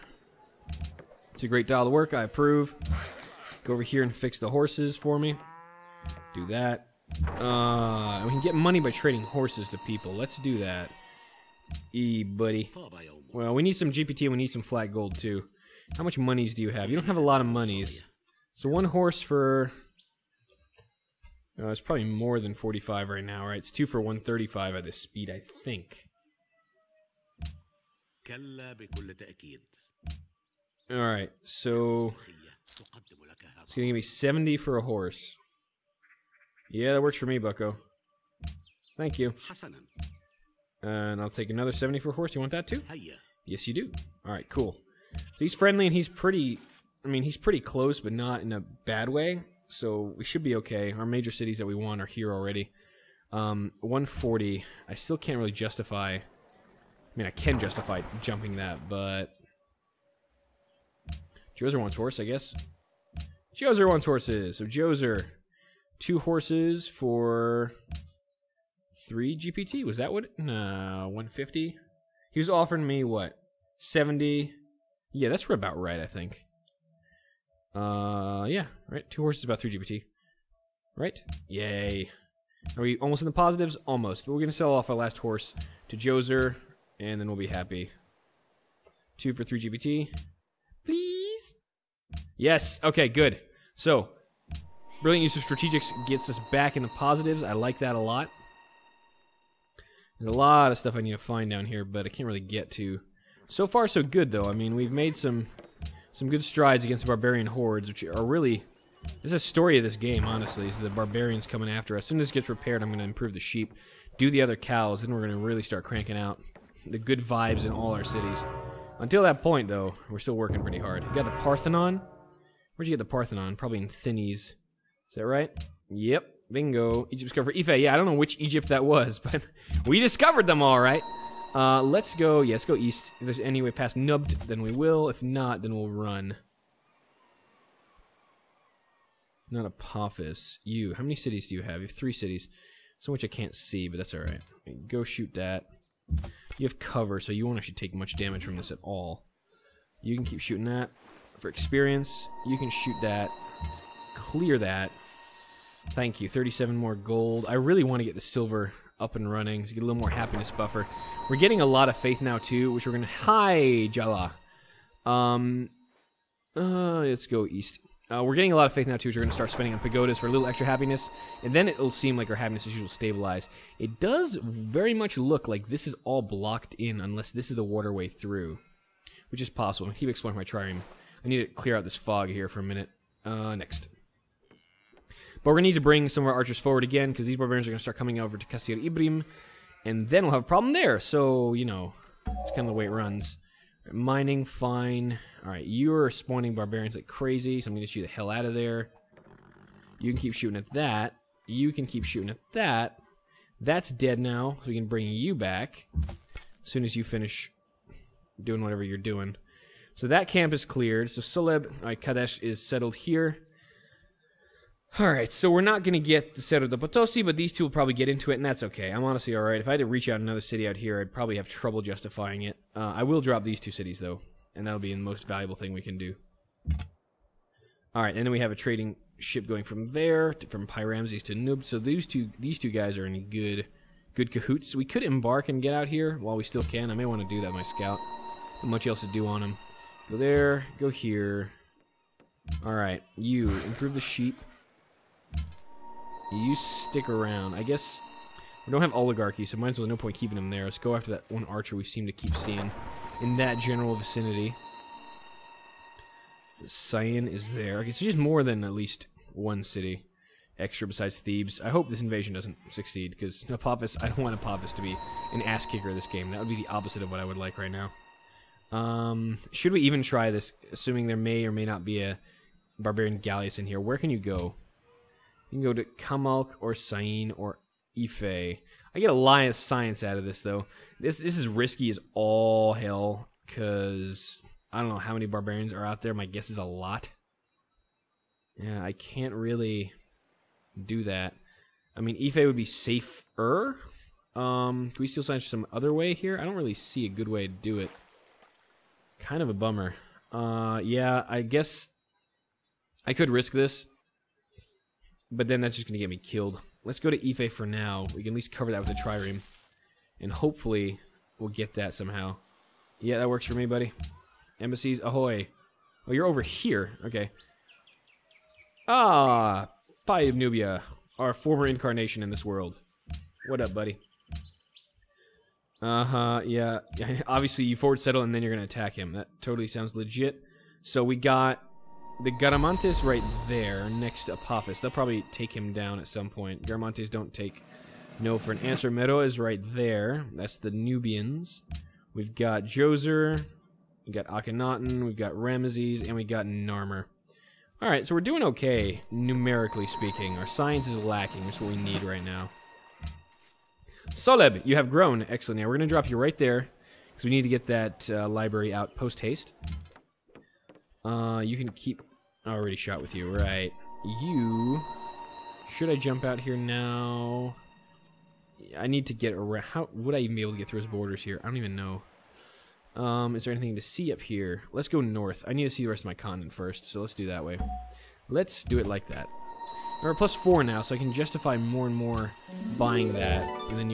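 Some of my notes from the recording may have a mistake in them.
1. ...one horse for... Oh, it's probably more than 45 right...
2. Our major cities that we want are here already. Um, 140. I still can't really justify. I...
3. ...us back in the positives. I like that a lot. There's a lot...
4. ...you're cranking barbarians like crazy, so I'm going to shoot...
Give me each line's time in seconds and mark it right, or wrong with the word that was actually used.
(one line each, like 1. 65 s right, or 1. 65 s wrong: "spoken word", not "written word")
1. 18 s right
2. 50 s right
3. 96 s right
4. 195 s wrong: "spawning", not "cranking".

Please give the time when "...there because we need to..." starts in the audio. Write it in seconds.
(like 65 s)
356 s.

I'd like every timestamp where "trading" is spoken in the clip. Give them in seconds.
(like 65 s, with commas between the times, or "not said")
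8 s, 228 s.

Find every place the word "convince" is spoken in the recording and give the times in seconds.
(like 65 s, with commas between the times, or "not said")
not said.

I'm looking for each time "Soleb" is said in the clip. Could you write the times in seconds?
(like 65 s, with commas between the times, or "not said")
211 s, 354 s.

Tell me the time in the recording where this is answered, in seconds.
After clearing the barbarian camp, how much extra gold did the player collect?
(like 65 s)
156 s.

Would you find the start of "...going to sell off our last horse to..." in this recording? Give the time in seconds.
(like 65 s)
84 s.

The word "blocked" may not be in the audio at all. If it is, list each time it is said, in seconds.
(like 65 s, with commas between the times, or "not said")
176 s.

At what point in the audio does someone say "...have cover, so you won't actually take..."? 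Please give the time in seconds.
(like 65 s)
146 s.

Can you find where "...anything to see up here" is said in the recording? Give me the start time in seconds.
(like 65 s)
373 s.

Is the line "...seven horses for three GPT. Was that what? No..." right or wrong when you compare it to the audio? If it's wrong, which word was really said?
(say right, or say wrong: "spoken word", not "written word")
wrong: "two", not "seven".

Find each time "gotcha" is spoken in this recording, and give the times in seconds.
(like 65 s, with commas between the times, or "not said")
not said.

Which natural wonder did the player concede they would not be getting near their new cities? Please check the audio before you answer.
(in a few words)
Cerro de Potosi.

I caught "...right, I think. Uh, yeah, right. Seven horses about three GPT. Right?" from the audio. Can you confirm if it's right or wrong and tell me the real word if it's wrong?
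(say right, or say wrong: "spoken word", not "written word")
wrong: "Two", not "Seven".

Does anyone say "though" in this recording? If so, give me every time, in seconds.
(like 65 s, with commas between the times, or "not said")
104 s, 119 s, 224 s, 280 s.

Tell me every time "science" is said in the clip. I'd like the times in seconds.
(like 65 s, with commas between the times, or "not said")
279 s, 295 s, 350 s.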